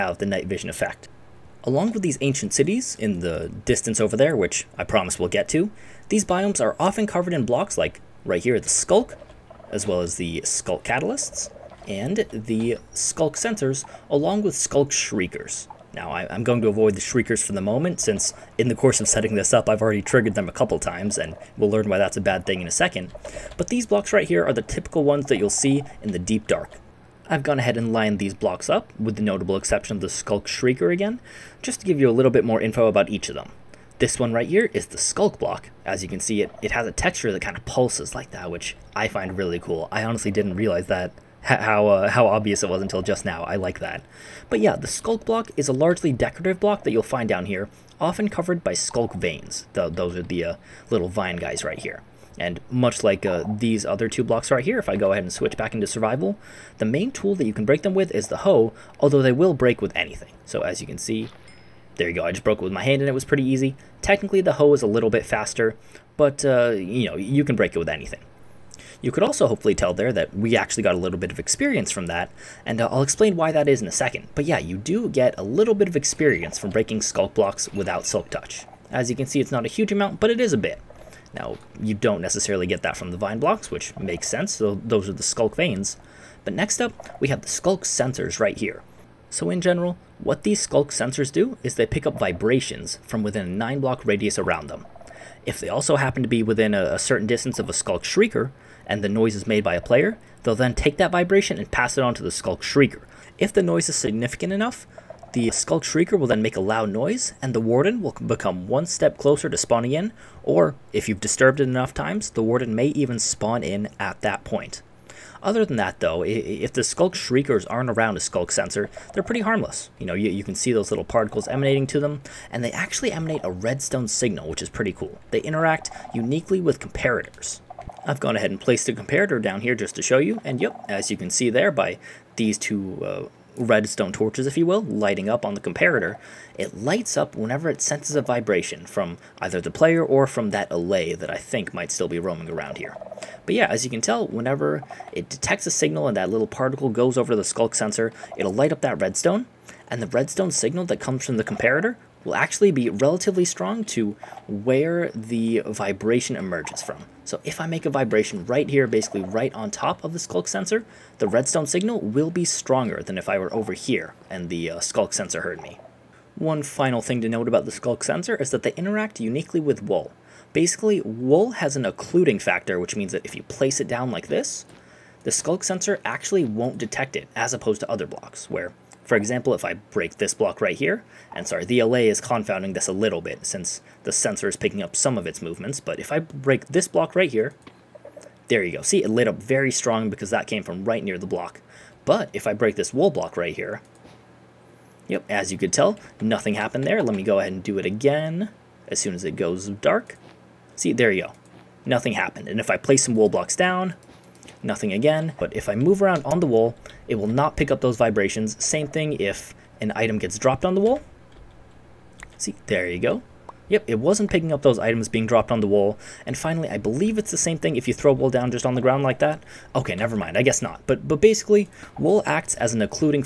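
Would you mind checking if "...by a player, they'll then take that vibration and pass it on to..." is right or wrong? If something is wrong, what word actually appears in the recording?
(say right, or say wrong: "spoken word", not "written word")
right.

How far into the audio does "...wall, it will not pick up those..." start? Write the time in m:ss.
3:26.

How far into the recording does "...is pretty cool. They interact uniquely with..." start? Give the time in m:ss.
2:04.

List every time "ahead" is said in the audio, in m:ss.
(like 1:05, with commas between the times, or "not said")
0:27, 0:55, 2:08, 3:17.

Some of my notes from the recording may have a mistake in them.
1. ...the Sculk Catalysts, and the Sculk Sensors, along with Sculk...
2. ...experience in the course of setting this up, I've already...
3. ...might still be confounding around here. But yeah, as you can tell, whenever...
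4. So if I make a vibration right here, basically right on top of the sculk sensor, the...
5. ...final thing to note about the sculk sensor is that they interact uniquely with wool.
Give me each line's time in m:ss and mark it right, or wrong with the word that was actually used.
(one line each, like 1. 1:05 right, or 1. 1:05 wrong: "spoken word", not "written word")
1. 0:10 right
2. 0:18 wrong: "since", not "experience"
3. 2:21 wrong: "roaming", not "confounding"
4. 2:37 right
5. 2:46 right.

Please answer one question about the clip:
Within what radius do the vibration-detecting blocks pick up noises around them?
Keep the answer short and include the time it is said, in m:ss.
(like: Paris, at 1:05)
9 block radius, at 1:33.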